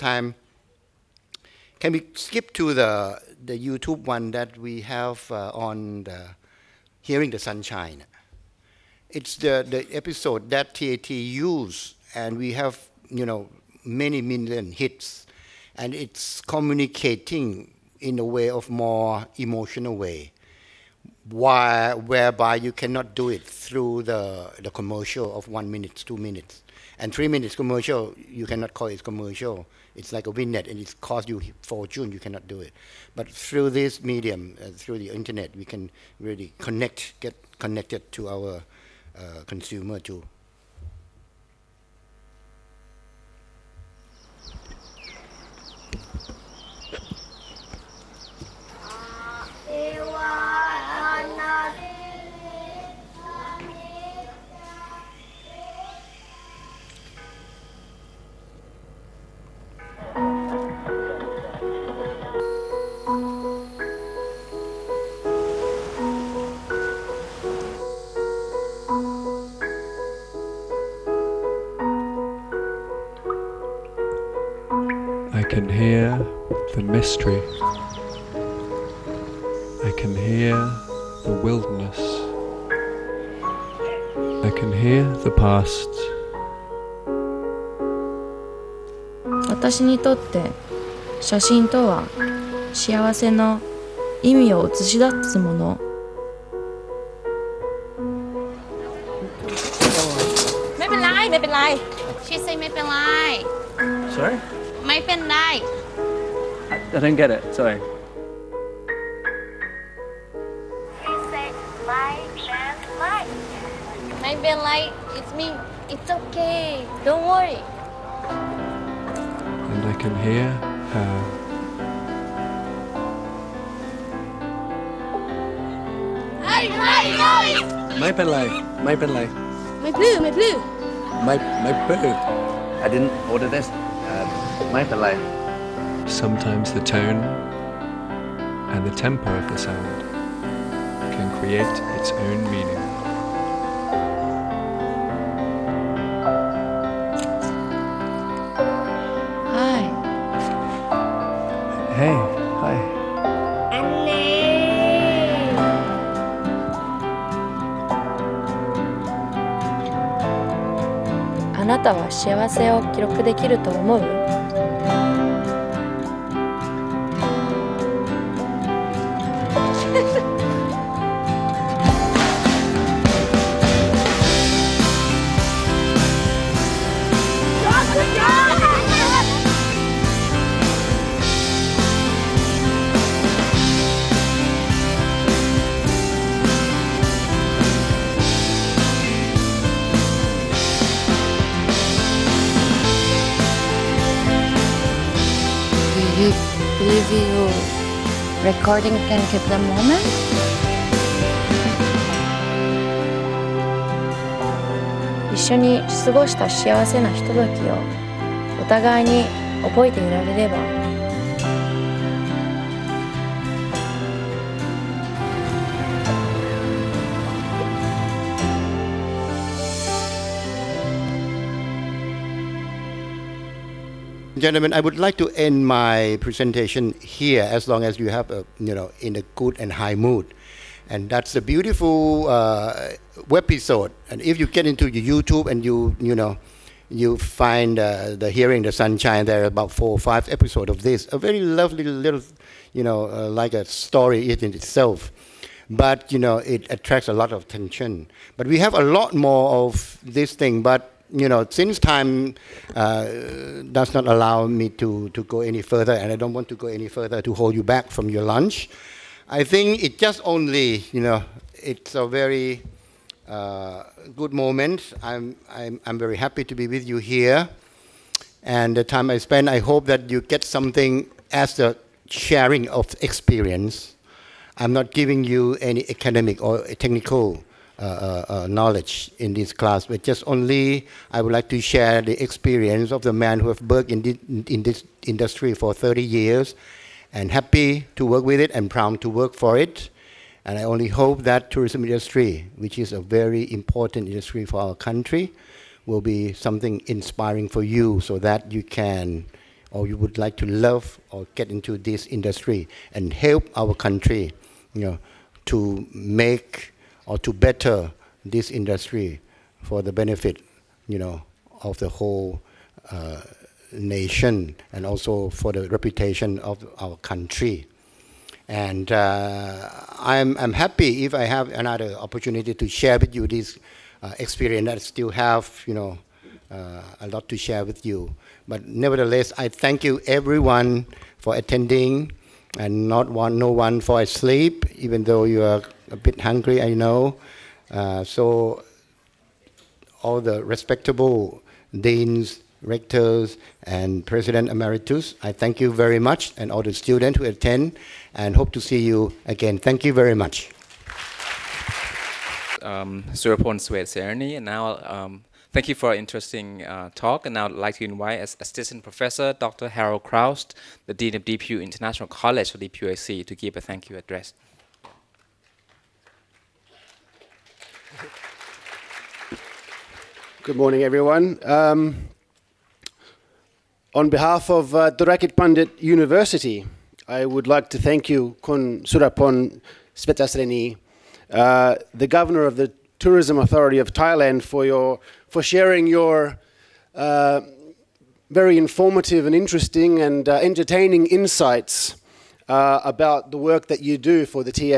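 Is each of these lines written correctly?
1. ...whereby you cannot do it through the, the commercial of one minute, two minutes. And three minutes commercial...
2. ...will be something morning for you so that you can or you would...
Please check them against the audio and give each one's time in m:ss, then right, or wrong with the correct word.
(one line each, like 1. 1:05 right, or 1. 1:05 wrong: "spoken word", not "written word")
1. 0:21 right
2. 4:55 wrong: "inspiring", not "morning".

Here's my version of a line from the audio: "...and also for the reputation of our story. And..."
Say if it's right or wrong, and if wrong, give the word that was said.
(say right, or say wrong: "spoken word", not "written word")
wrong: "country", not "story".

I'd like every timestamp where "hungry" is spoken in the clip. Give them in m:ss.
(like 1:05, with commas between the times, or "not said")
5:36.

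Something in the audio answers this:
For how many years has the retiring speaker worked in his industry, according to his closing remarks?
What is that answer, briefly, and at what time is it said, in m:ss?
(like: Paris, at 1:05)
30, at 4:45.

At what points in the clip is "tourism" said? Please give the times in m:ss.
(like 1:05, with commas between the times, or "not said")
4:51, 6:22.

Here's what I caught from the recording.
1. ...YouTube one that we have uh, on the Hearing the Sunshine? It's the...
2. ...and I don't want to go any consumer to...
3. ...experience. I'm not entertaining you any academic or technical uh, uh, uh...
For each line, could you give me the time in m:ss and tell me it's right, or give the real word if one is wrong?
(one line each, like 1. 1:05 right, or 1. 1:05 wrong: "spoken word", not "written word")
1. 0:03 right
2. 4:15 wrong: "further", not "consumer"
3. 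4:33 wrong: "giving", not "entertaining".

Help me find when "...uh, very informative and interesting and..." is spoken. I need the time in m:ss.
6:26.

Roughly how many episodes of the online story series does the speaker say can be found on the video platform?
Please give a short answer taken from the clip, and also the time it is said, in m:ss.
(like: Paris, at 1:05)
4 or 5, at 3:59.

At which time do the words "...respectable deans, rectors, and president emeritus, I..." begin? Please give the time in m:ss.
5:40.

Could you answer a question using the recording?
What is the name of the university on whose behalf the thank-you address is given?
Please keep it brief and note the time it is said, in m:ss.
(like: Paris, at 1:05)
Dhurakij Pundit University, at 6:14.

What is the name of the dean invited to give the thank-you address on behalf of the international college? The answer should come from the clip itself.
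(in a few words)
Harold Kraust.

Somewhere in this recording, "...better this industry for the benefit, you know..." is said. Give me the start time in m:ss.
5:07.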